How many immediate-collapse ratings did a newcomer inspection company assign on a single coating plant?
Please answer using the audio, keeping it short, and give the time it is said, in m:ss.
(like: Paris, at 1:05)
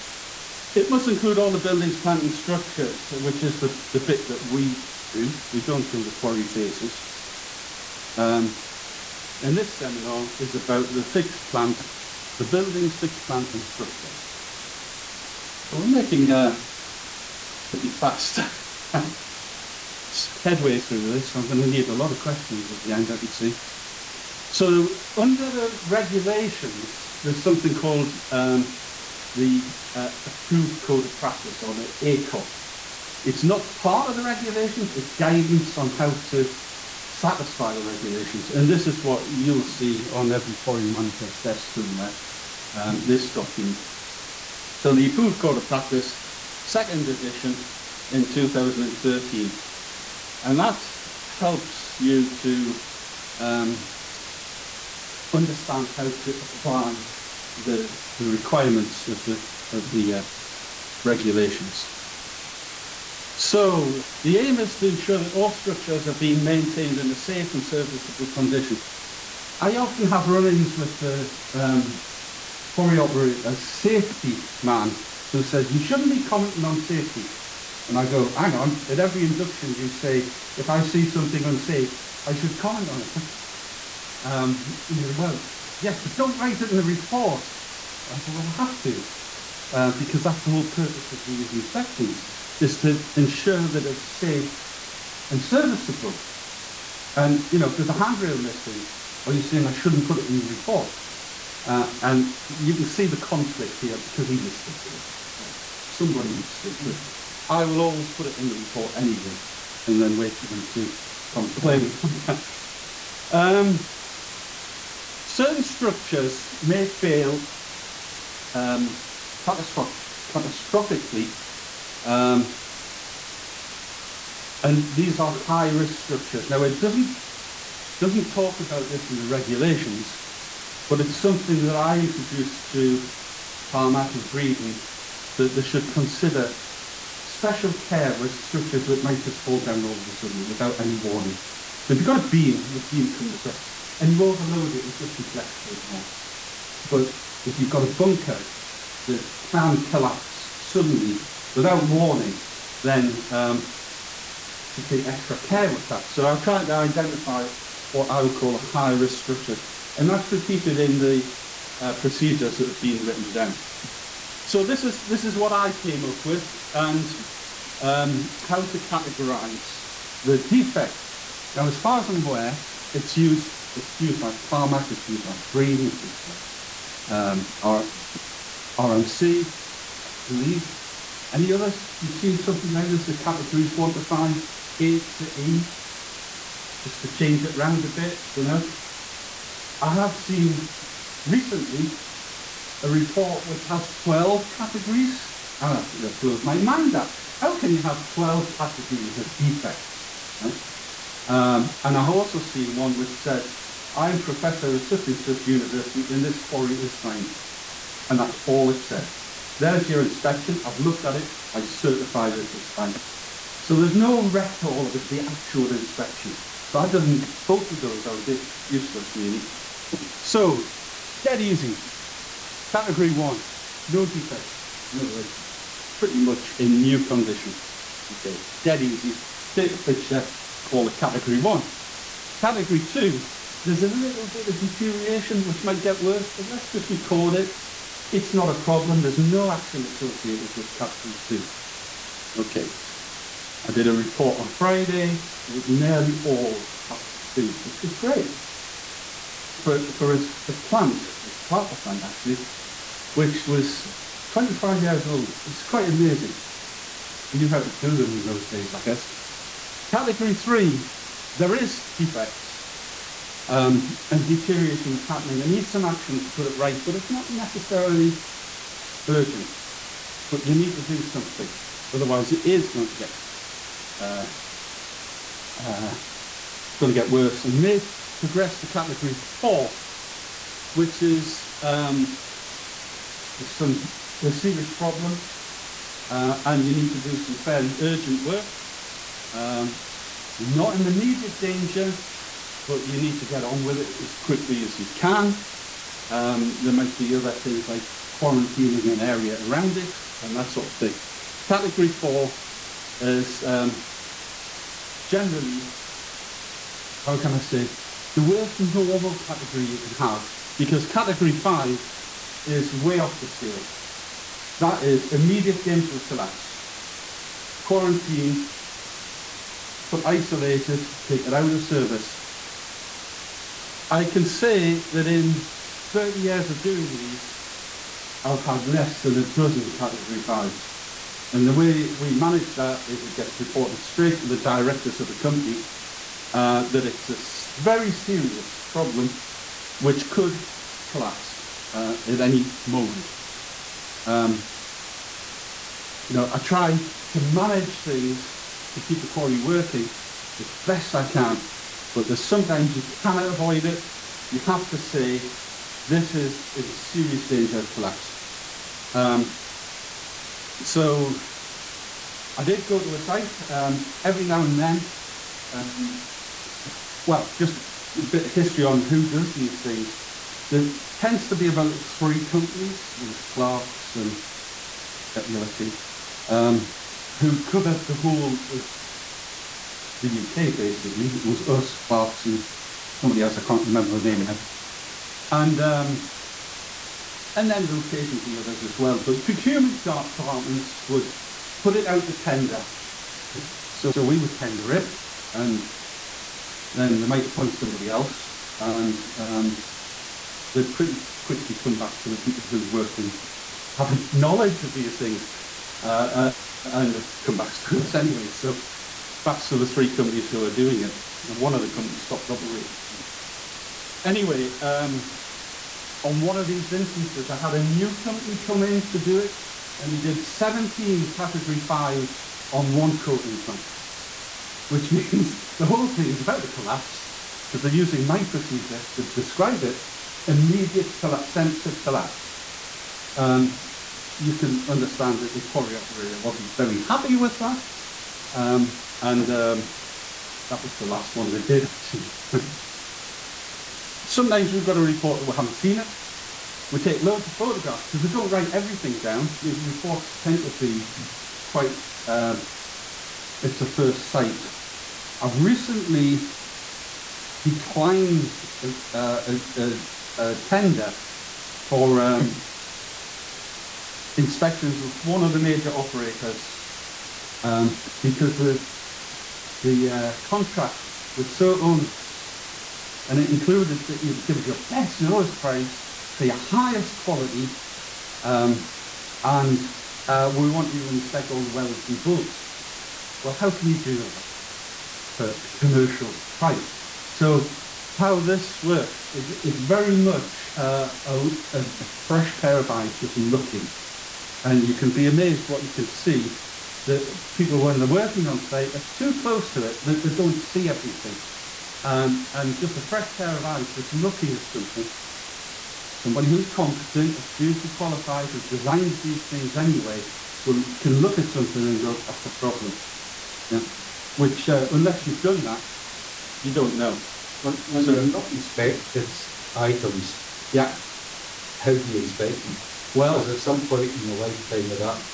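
17, at 7:00.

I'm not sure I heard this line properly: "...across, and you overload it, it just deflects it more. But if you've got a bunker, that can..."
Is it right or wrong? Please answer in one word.
right.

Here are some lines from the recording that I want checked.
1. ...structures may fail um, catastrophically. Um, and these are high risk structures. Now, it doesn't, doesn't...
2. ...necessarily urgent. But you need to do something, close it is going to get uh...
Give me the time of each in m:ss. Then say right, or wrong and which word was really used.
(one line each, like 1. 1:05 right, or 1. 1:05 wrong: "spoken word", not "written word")
1. 1:55 right
2. 4:27 wrong: "otherwise", not "close".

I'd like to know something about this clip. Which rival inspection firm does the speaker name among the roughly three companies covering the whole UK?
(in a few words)
Clarkson.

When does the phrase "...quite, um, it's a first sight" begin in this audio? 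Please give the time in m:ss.
7:31.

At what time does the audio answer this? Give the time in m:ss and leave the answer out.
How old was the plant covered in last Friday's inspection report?
4:14.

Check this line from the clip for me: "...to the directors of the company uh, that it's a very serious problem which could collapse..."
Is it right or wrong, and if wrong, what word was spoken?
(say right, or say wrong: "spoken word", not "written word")
right.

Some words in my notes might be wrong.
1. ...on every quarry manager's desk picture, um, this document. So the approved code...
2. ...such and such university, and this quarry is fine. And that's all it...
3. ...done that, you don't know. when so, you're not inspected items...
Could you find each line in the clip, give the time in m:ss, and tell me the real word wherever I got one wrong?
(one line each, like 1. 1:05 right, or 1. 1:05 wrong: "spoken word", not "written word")
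1. 0:40 wrong: "somewhere", not "picture"
2. 3:24 right
3. 8:35 right.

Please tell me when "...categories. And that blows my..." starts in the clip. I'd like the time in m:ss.
3:14.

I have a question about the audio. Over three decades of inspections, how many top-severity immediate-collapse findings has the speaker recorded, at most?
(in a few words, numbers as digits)
less than a dozen.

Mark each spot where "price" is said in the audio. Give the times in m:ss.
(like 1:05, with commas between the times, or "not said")
7:55, 8:06.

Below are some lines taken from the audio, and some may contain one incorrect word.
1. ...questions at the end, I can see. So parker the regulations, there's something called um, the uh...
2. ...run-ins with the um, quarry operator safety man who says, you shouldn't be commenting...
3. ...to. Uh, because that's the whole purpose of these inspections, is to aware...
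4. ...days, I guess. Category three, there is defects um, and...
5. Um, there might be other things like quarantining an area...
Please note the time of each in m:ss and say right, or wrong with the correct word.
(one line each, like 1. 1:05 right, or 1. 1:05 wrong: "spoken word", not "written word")
1. 0:22 wrong: "under", not "parker"
2. 1:10 right
3. 1:28 wrong: "ensure", not "aware"
4. 4:18 right
5. 4:56 right.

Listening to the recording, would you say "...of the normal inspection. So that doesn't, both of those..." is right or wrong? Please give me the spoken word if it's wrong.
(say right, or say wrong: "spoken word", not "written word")
wrong: "actual", not "normal".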